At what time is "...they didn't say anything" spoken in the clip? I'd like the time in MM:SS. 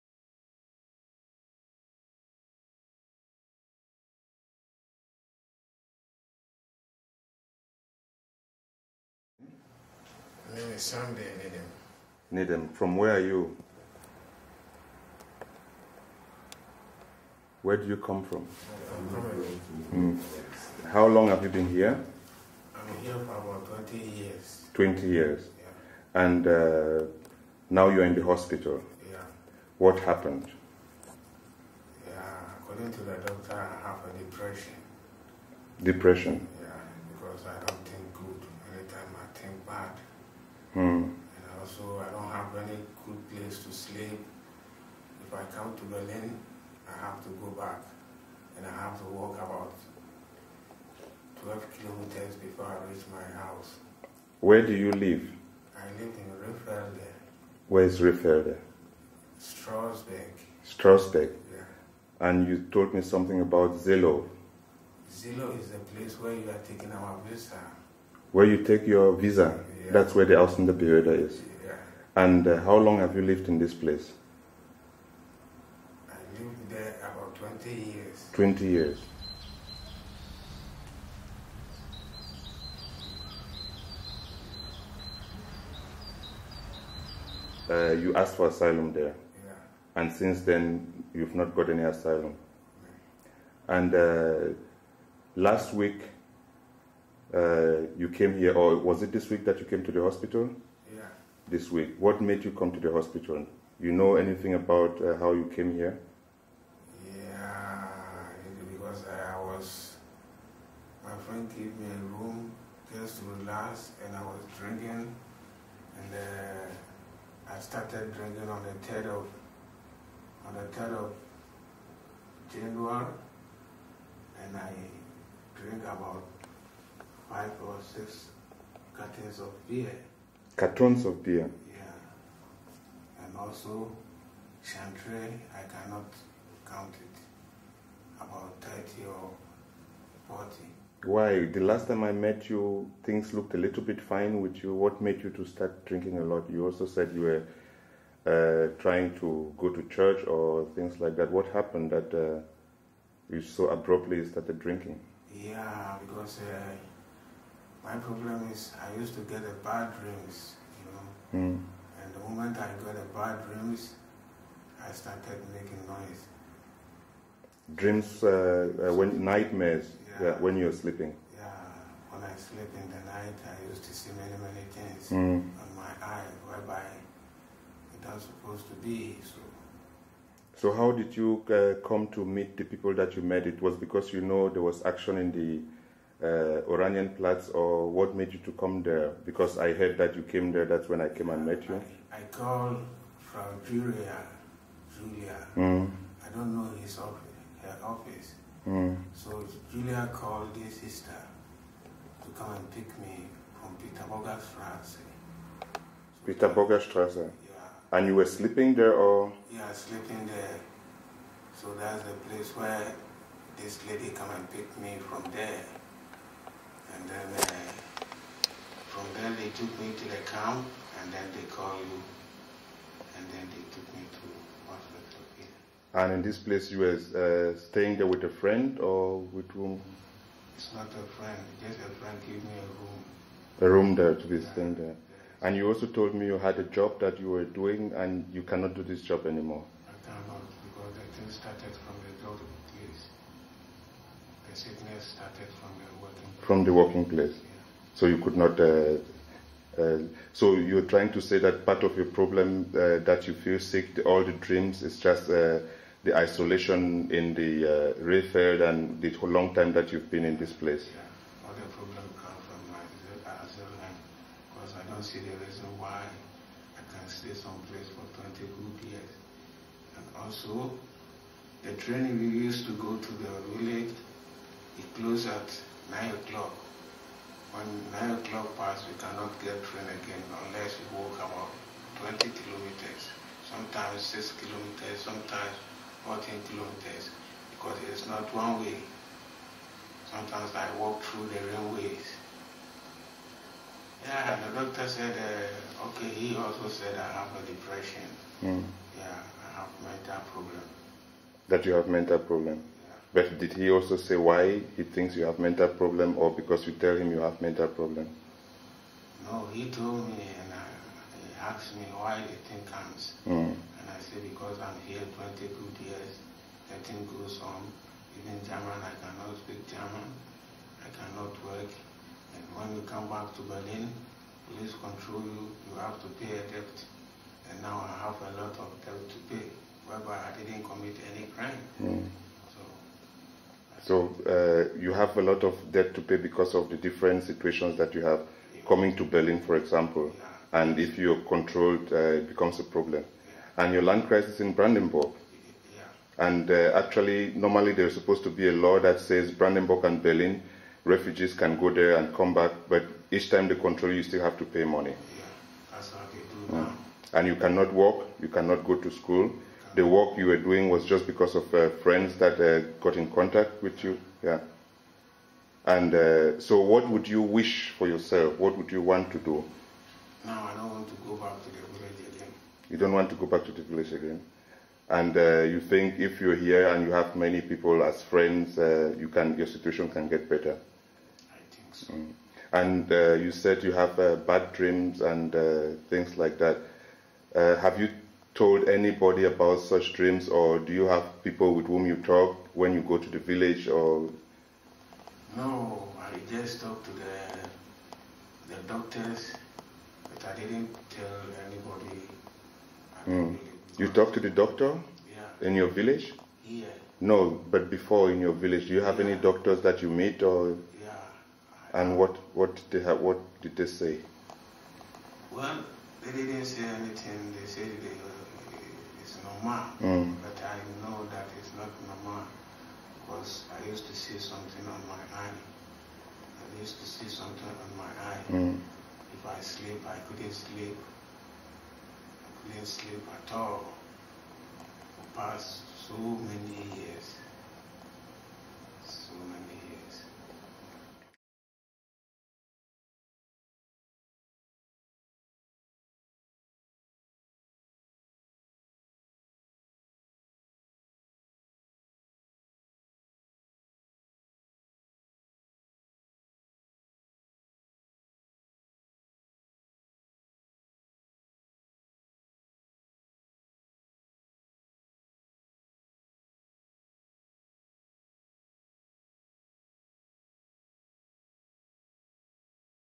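06:56.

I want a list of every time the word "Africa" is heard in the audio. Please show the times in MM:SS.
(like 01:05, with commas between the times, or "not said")
03:44.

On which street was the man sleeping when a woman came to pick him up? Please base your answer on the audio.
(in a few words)
Petersburger Strasse.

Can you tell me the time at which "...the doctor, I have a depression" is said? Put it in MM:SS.
00:33.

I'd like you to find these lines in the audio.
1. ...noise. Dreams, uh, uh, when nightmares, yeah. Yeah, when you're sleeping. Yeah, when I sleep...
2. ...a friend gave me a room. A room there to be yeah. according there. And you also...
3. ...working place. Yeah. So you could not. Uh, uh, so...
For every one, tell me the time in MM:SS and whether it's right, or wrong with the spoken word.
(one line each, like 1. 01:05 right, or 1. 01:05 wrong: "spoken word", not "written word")
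1. 02:45 right
2. 03:51 wrong: "staying", not "according"
3. 04:06 right.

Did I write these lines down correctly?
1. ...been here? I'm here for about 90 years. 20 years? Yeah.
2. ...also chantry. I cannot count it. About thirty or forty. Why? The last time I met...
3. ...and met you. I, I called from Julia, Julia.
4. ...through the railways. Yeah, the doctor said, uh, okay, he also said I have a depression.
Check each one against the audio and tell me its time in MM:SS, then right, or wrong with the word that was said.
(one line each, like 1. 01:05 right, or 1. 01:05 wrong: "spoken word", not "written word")
1. 00:21 wrong: "20", not "90"
2. 02:13 right
3. 03:11 right
4. 04:51 right.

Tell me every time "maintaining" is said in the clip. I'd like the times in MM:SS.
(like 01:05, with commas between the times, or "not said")
not said.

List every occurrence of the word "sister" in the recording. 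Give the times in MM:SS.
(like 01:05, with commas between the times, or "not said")
03:20.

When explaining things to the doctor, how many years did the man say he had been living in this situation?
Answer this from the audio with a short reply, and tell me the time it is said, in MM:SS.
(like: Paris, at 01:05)
22 years, at 05:15.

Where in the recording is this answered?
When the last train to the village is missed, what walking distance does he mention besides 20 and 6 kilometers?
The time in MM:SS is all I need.
04:46.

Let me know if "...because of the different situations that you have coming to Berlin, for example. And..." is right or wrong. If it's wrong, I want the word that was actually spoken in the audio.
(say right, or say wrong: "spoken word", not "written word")
right.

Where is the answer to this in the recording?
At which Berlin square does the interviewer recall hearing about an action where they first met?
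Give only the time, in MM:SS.
03:06.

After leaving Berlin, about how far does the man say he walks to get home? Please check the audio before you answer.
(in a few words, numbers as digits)
12 kilometers.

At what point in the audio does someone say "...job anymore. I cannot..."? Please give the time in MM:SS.
03:59.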